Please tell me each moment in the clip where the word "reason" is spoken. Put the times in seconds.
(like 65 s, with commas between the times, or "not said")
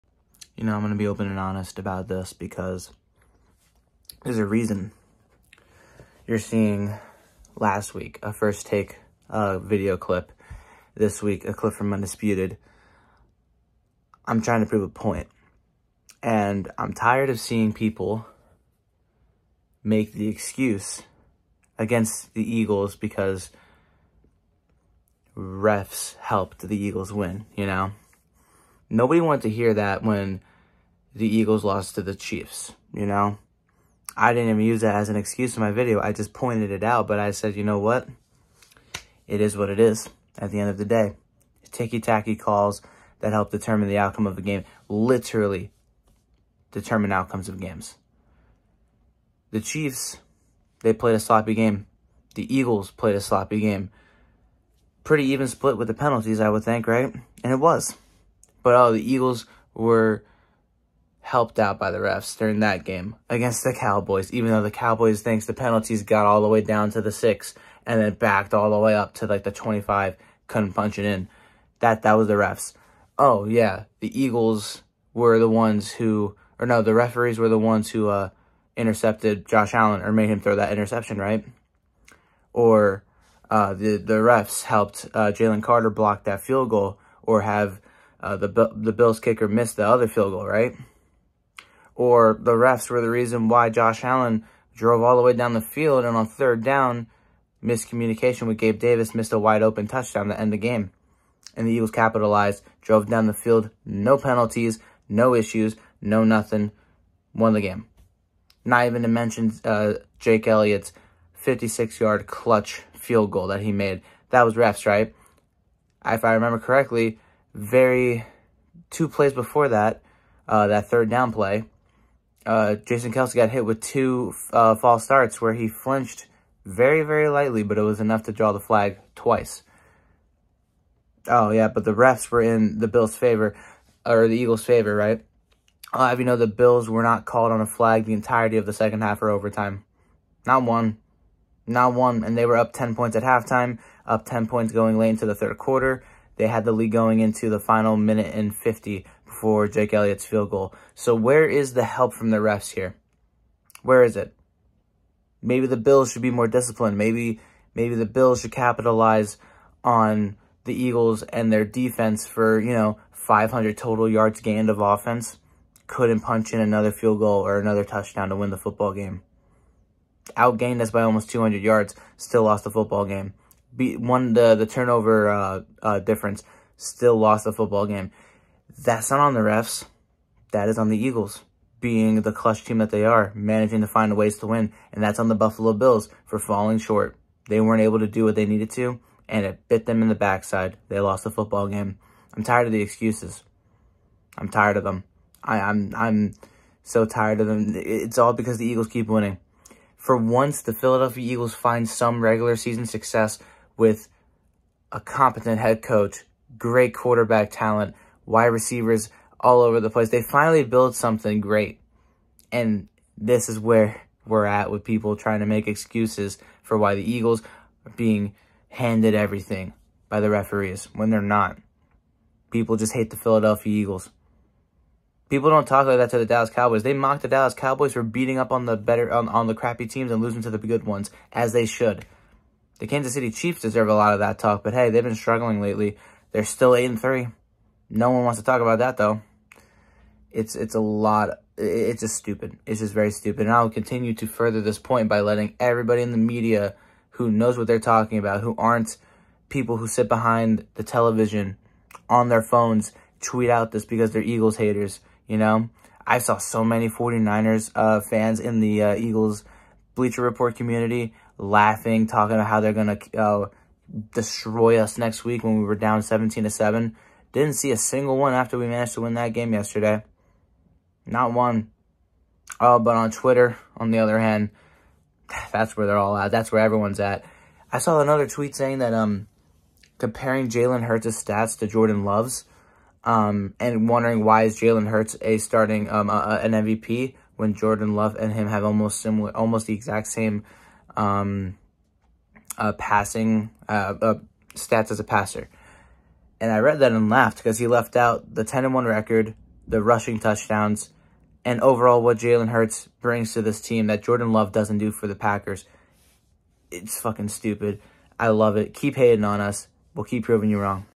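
4 s, 93 s.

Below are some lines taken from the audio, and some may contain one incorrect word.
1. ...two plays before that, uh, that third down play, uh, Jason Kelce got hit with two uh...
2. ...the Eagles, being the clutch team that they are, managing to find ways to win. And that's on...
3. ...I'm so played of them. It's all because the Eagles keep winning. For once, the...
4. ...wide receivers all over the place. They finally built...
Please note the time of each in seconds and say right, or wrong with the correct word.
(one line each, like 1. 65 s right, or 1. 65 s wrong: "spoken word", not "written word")
1. 118 s right
2. 180 s right
3. 195 s wrong: "tired", not "played"
4. 208 s right.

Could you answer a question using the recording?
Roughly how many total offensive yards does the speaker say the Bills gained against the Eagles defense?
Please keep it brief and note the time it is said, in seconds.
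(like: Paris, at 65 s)
500, at 163 s.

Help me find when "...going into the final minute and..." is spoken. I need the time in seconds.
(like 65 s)
146 s.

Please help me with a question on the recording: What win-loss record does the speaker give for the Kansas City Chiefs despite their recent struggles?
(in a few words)
8-3.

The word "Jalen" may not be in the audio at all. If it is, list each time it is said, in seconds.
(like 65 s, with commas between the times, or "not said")
85 s, 280 s, 284 s, 302 s.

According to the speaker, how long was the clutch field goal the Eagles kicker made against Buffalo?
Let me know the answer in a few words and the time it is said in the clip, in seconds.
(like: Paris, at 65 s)
56 yards, at 111 s.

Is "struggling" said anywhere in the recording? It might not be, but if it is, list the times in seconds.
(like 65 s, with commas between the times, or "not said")
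235 s.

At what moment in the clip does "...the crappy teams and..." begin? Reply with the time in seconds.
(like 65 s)
229 s.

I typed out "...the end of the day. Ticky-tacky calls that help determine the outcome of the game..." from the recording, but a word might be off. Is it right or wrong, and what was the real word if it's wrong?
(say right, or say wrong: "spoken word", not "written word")
right.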